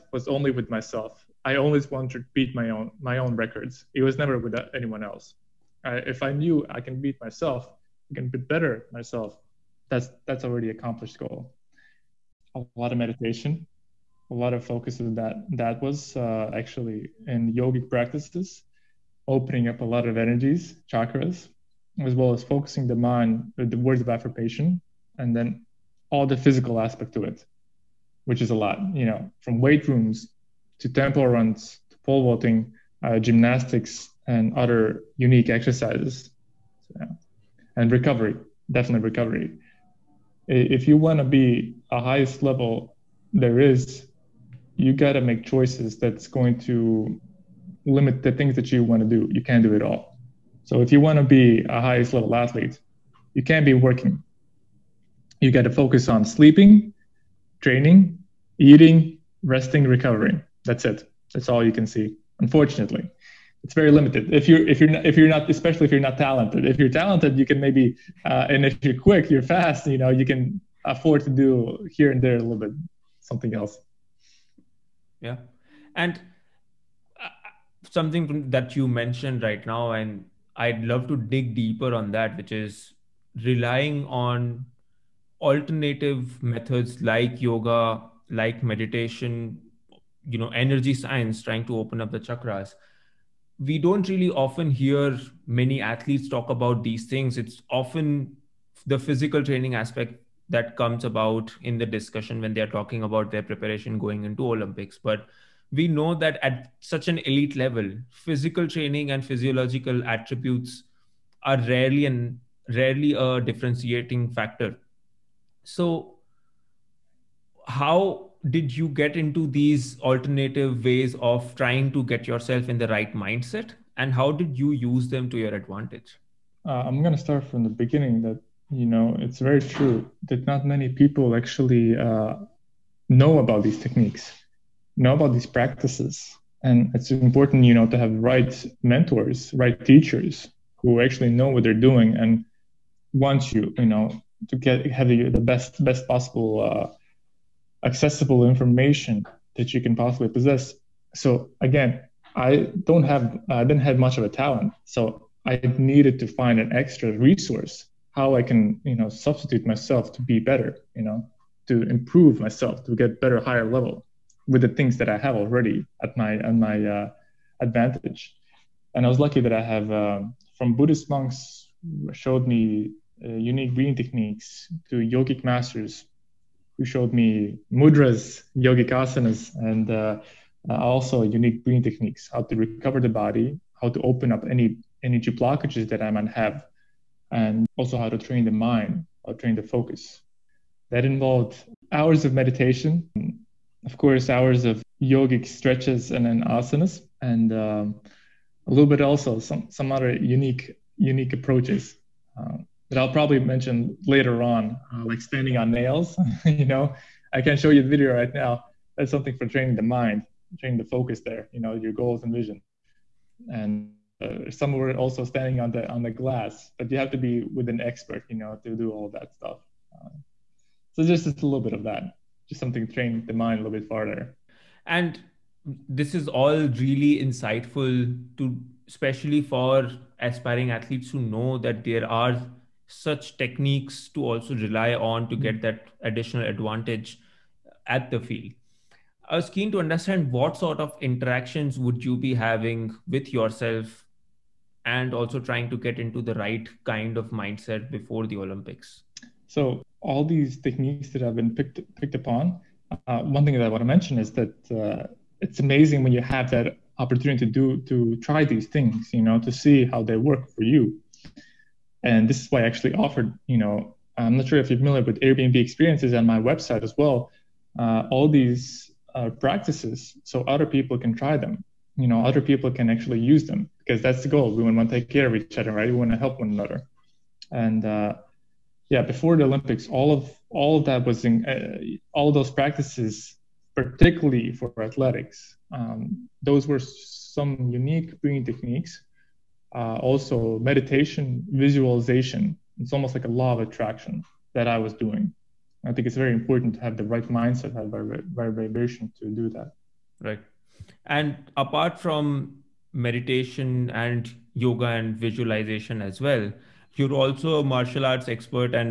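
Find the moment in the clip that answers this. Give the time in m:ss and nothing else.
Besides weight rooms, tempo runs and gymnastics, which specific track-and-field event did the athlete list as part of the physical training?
0:31.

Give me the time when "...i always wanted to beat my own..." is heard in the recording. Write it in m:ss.
0:01.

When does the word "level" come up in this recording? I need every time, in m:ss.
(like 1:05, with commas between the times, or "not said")
0:42, 0:52, 1:47, 2:43.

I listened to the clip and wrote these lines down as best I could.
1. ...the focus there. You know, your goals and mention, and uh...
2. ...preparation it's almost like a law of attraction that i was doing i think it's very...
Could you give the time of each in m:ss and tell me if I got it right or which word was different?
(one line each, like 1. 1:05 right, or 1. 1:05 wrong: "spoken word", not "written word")
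1. 3:30 wrong: "vision", not "mention"
2. 4:51 wrong: "visualization", not "preparation".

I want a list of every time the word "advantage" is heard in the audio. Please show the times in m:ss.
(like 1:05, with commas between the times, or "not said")
2:05, 2:47, 3:56.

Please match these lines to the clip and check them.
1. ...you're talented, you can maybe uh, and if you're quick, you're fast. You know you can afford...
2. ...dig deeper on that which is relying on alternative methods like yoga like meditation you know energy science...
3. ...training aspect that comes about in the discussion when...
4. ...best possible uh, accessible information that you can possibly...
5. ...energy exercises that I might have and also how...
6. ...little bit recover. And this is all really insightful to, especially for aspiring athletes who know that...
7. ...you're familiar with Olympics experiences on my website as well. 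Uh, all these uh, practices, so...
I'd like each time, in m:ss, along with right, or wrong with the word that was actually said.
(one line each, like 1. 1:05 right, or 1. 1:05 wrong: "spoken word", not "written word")
1. 1:06 right
2. 1:21 right
3. 1:39 right
4. 2:25 right
5. 3:05 wrong: "blockages", not "exercises"
6. 3:43 wrong: "farther", not "recover"
7. 4:24 wrong: "Airbnb", not "Olympics".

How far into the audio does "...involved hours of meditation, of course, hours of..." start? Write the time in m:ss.
3:11.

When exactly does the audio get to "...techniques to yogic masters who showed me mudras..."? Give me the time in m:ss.
2:54.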